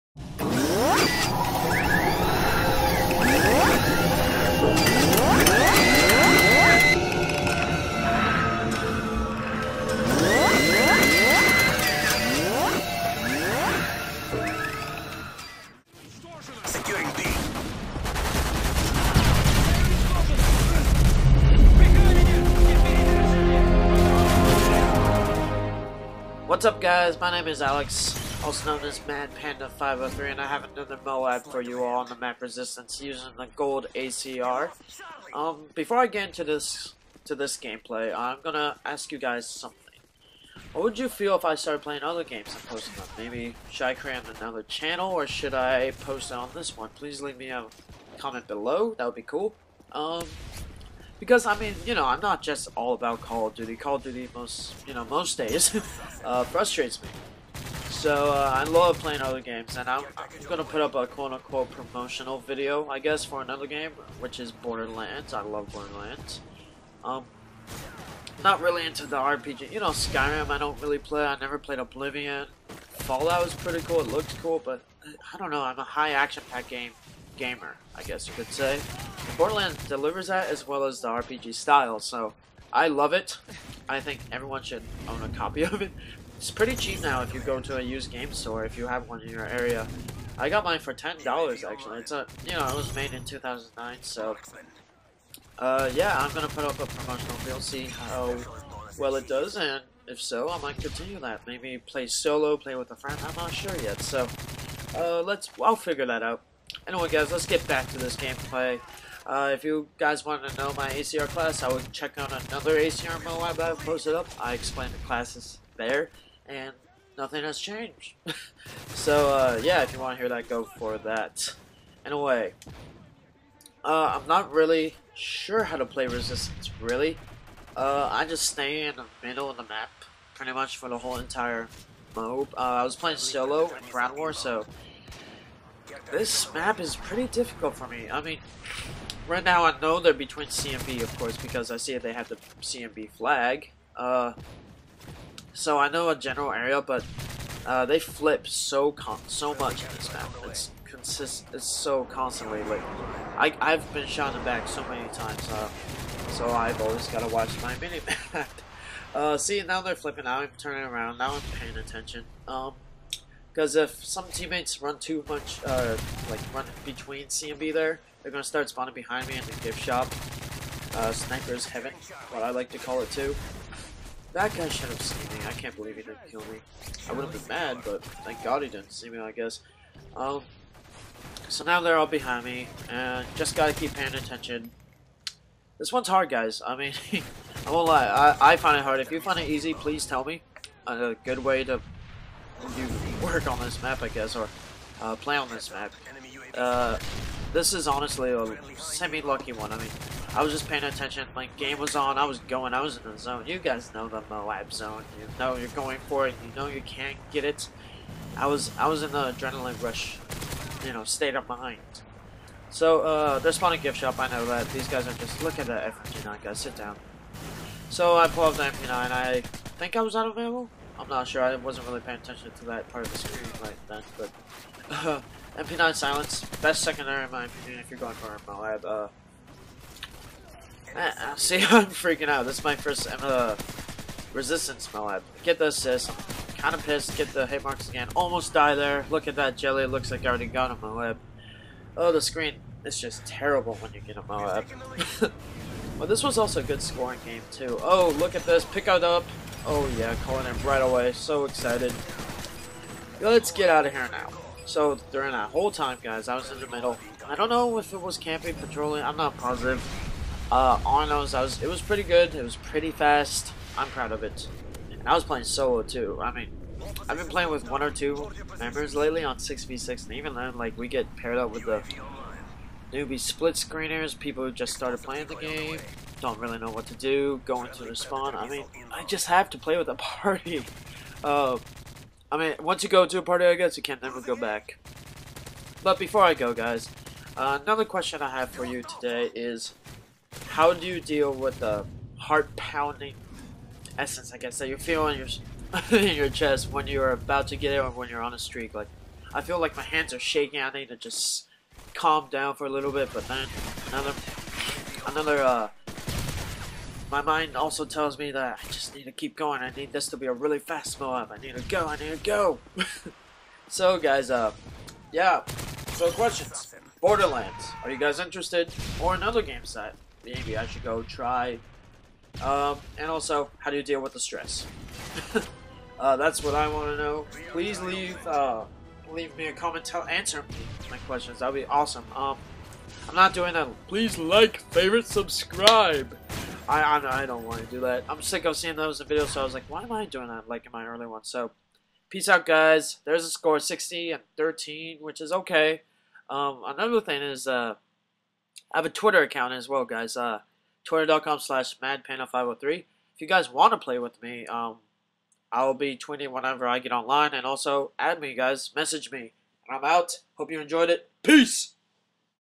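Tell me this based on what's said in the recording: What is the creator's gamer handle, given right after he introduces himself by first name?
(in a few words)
Mad Panda 503.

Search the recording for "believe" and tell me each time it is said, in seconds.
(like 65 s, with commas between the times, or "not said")
175 s.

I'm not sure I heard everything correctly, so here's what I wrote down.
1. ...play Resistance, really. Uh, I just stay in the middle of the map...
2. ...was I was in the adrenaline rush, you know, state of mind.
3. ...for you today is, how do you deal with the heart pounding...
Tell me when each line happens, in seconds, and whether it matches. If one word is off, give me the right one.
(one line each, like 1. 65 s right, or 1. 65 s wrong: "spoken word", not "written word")
1. 125 s right
2. 208 s right
3. 288 s right.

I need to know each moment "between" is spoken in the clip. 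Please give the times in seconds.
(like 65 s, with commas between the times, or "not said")
140 s, 166 s.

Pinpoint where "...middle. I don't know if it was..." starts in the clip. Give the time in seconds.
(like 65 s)
256 s.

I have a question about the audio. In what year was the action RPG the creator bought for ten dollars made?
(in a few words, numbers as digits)
2009.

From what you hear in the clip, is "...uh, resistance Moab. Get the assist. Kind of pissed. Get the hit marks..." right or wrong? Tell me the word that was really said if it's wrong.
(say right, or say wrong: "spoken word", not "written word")
right.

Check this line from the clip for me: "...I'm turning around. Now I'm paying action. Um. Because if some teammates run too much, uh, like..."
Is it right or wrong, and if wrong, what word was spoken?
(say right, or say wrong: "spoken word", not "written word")
wrong: "attention", not "action".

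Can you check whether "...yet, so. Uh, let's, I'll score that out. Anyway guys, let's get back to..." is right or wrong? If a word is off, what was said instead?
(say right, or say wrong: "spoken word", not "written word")
wrong: "figure", not "score".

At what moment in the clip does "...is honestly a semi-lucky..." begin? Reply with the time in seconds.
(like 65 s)
197 s.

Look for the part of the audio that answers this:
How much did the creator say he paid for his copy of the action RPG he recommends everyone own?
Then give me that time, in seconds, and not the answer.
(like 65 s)
90 s.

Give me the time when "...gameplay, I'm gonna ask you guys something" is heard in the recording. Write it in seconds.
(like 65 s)
37 s.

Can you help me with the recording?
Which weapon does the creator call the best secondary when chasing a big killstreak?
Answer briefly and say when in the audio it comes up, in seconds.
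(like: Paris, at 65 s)
MP9 Silenced, at 225 s.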